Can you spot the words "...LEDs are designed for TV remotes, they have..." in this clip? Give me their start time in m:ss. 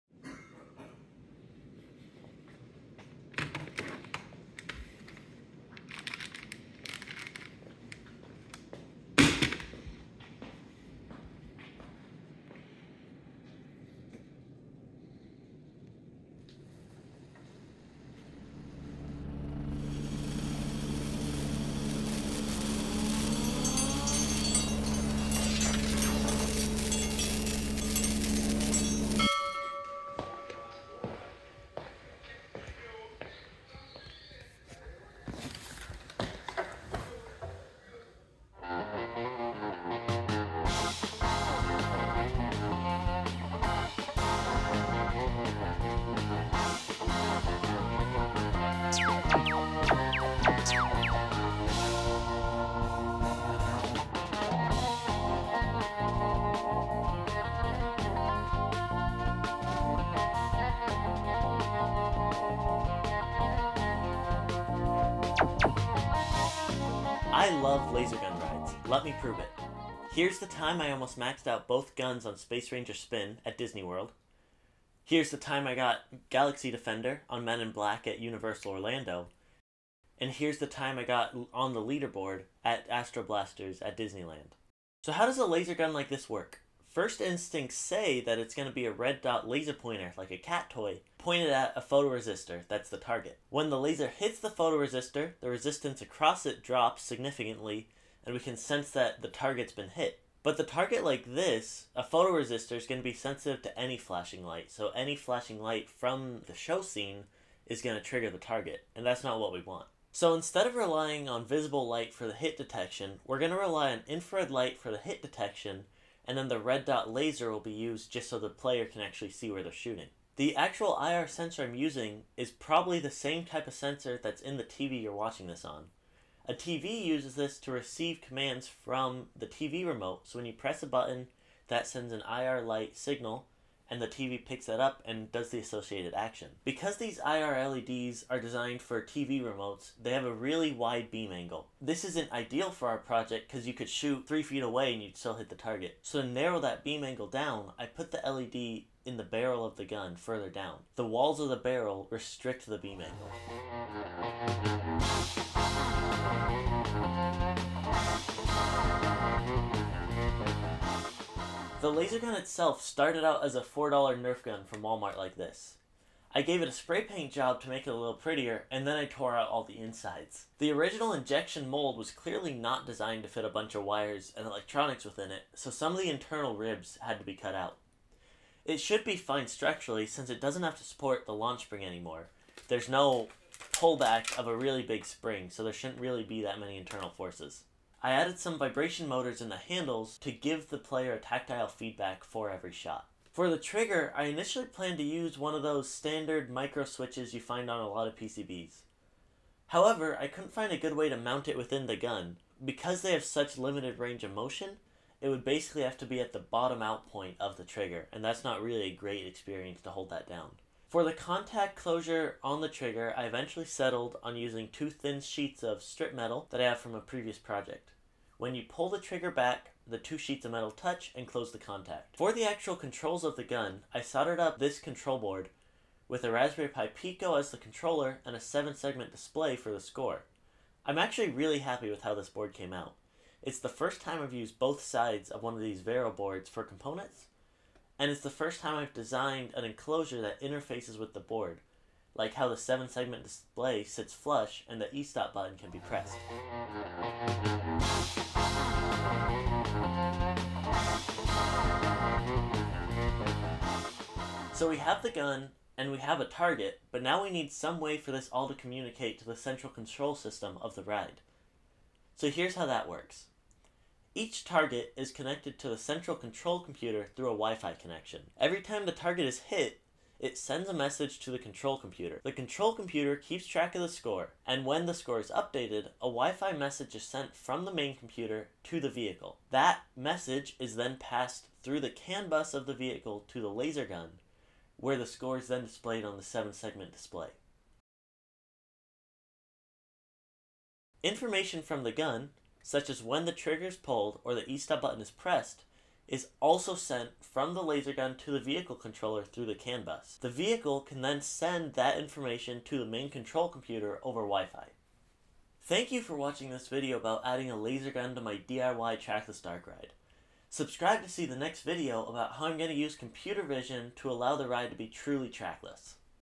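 2:17.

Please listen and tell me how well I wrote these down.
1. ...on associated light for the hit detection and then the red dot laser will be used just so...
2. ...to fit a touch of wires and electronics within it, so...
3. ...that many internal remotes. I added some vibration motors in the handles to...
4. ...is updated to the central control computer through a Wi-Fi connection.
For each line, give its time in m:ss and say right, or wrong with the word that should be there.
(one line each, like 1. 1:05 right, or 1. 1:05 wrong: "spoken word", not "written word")
1. 1:53 wrong: "infrared", not "associated"
2. 2:53 wrong: "bunch", not "touch"
3. 3:06 wrong: "forces", not "remotes"
4. 4:24 wrong: "connected", not "updated".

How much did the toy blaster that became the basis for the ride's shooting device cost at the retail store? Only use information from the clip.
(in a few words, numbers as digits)
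$4.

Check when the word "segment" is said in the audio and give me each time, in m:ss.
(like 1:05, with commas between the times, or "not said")
3:48, 4:02, 4:46.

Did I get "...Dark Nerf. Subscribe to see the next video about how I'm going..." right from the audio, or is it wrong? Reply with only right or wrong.
wrong.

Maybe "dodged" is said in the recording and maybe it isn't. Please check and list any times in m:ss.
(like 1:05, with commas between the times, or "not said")
not said.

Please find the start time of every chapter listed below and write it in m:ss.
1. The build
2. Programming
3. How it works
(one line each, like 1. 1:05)
1. 2:41
2. 4:14
3. 1:25.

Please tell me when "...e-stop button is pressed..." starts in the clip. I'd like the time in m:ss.
4:54.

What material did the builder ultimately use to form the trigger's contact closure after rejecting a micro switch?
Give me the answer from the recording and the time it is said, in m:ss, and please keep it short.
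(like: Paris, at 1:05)
strip metal, at 3:35.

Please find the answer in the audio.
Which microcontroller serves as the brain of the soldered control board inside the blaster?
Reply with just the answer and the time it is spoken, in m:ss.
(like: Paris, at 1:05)
Raspberry Pi Pico, at 3:46.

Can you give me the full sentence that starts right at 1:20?
And here's the time I got on the leaderboard at Astro Blasters at Disneyland.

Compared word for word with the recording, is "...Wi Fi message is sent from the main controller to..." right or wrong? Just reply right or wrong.
wrong.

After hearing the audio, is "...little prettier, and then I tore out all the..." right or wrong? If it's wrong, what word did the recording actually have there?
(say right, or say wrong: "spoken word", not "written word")
right.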